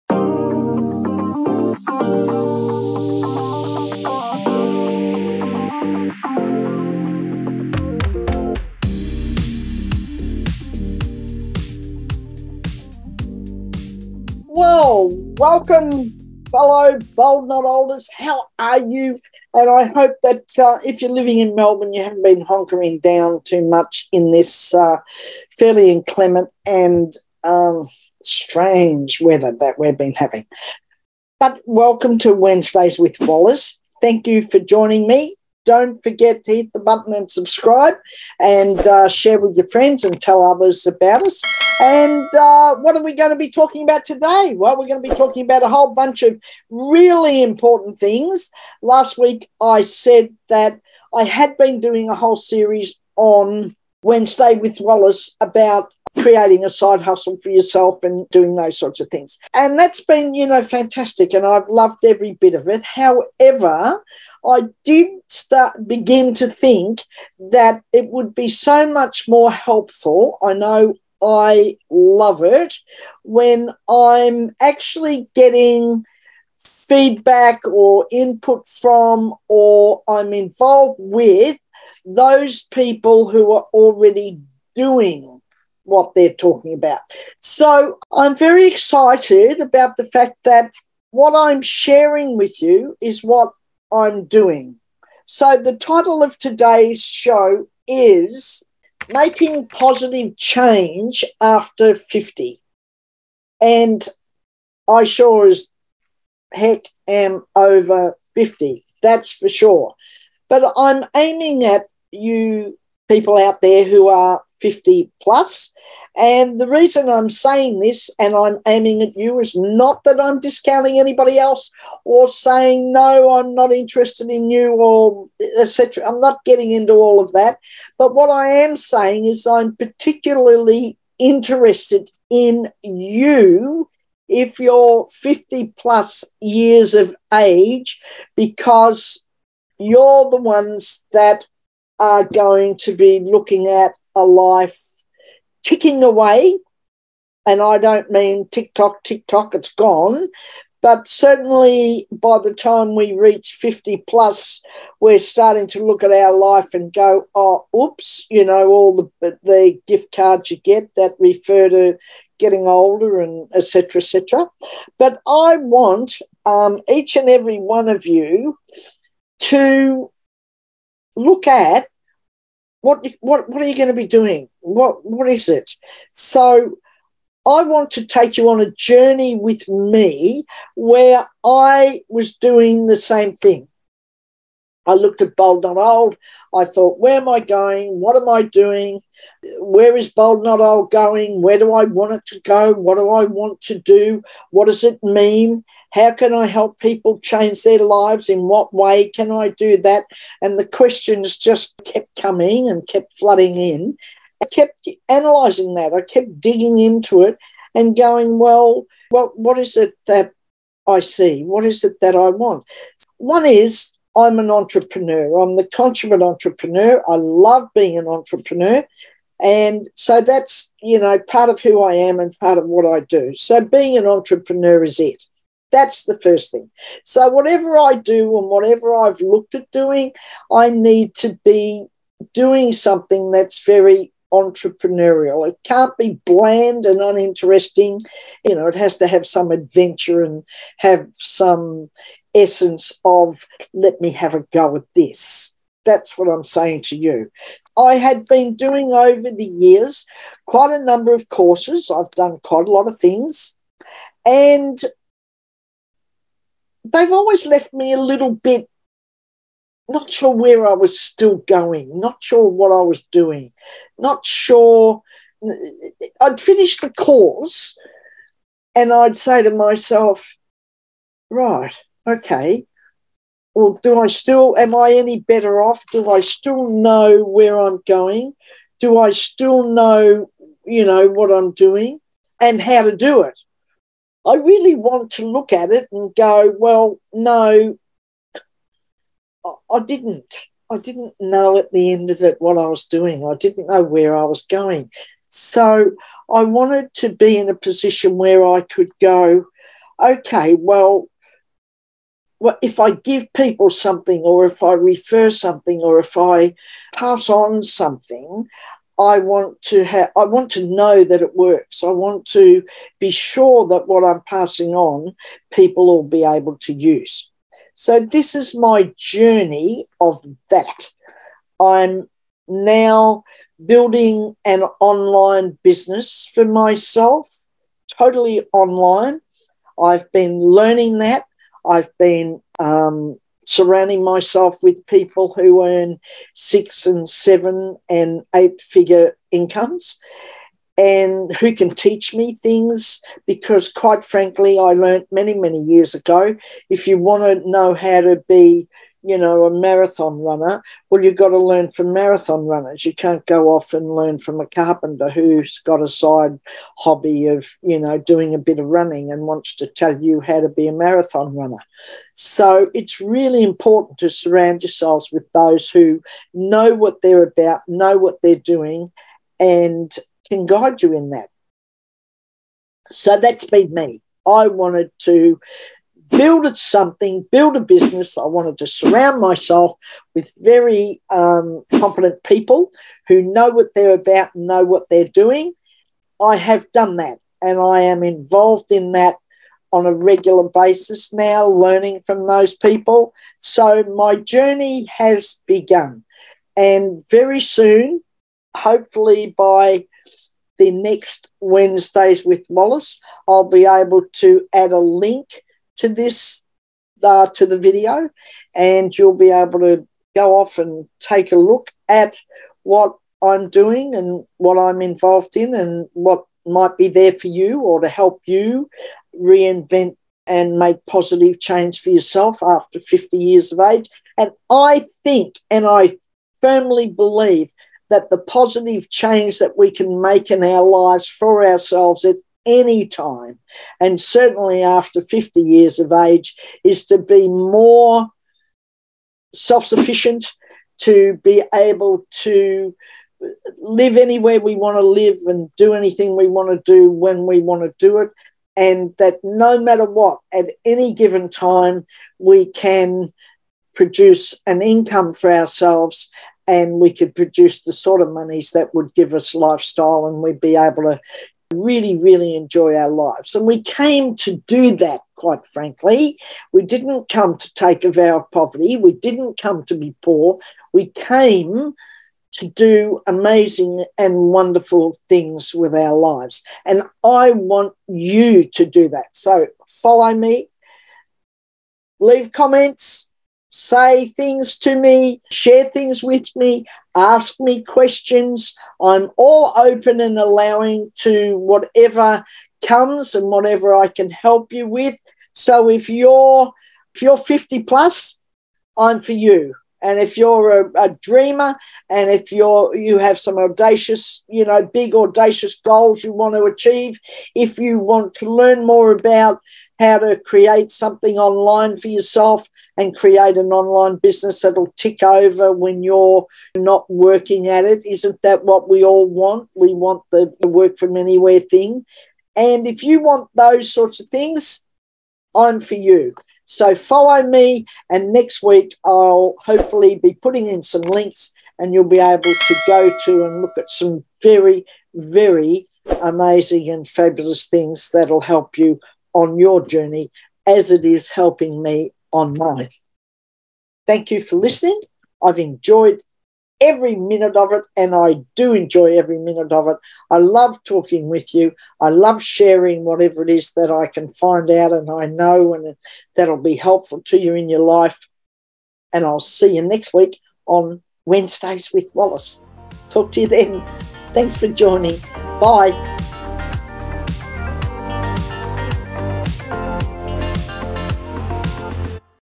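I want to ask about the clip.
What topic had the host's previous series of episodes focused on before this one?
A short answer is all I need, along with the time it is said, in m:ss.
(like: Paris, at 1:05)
creating a side hustle, at 0:56.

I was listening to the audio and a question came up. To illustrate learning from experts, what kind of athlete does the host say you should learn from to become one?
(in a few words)
marathon runners.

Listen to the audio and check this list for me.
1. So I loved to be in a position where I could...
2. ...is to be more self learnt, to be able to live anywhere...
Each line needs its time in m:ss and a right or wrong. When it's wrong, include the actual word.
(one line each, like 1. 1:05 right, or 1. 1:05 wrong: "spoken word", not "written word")
1. 4:55 wrong: "wanted", not "loved"
2. 7:16 wrong: "sufficient", not "learnt".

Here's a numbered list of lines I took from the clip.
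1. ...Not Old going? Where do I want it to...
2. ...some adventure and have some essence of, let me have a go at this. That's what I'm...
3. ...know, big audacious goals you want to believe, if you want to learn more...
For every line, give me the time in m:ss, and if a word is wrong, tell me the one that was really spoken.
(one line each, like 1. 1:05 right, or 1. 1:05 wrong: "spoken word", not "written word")
1. 3:10 right
2. 3:59 right
3. 8:24 wrong: "achieve", not "believe".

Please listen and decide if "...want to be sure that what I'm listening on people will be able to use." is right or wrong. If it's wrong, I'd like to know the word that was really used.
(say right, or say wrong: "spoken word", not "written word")
wrong: "passing", not "listening".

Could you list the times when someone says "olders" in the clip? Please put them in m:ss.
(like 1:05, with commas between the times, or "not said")
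0:17, 2:42.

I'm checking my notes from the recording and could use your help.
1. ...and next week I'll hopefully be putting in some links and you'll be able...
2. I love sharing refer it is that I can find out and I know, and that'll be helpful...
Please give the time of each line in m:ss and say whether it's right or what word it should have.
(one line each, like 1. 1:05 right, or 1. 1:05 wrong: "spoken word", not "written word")
1. 8:47 right
2. 9:11 wrong: "whatever", not "refer".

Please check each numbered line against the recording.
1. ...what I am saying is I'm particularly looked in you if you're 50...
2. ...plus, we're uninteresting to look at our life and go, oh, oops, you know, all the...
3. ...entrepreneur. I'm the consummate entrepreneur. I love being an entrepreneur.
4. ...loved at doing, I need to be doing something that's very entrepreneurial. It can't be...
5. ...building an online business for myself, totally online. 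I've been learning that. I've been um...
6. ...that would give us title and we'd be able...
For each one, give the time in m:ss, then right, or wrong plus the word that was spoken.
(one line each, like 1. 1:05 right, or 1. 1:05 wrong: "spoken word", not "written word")
1. 2:08 wrong: "interested", not "looked"
2. 2:34 wrong: "starting", not "uninteresting"
3. 3:34 right
4. 3:49 wrong: "looked", not "loved"
5. 5:23 right
6. 7:38 wrong: "lifestyle", not "title".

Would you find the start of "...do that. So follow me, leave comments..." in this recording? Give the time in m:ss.
7:58.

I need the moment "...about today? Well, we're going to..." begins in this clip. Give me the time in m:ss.
0:43.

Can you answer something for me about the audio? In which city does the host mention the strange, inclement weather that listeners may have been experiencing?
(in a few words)
Melbourne.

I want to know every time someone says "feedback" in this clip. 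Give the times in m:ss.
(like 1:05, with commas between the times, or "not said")
1:16.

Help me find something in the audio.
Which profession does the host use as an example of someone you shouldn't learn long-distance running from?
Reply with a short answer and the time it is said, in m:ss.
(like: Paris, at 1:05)
a carpenter, at 5:54.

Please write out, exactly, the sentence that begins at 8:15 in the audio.
So if you're if you're 50 plus, I'm for you.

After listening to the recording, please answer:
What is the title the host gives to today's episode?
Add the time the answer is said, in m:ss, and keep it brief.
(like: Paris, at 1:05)
Making Positive Change After 50, at 1:39.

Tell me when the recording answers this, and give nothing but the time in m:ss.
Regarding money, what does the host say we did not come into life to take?
7:47.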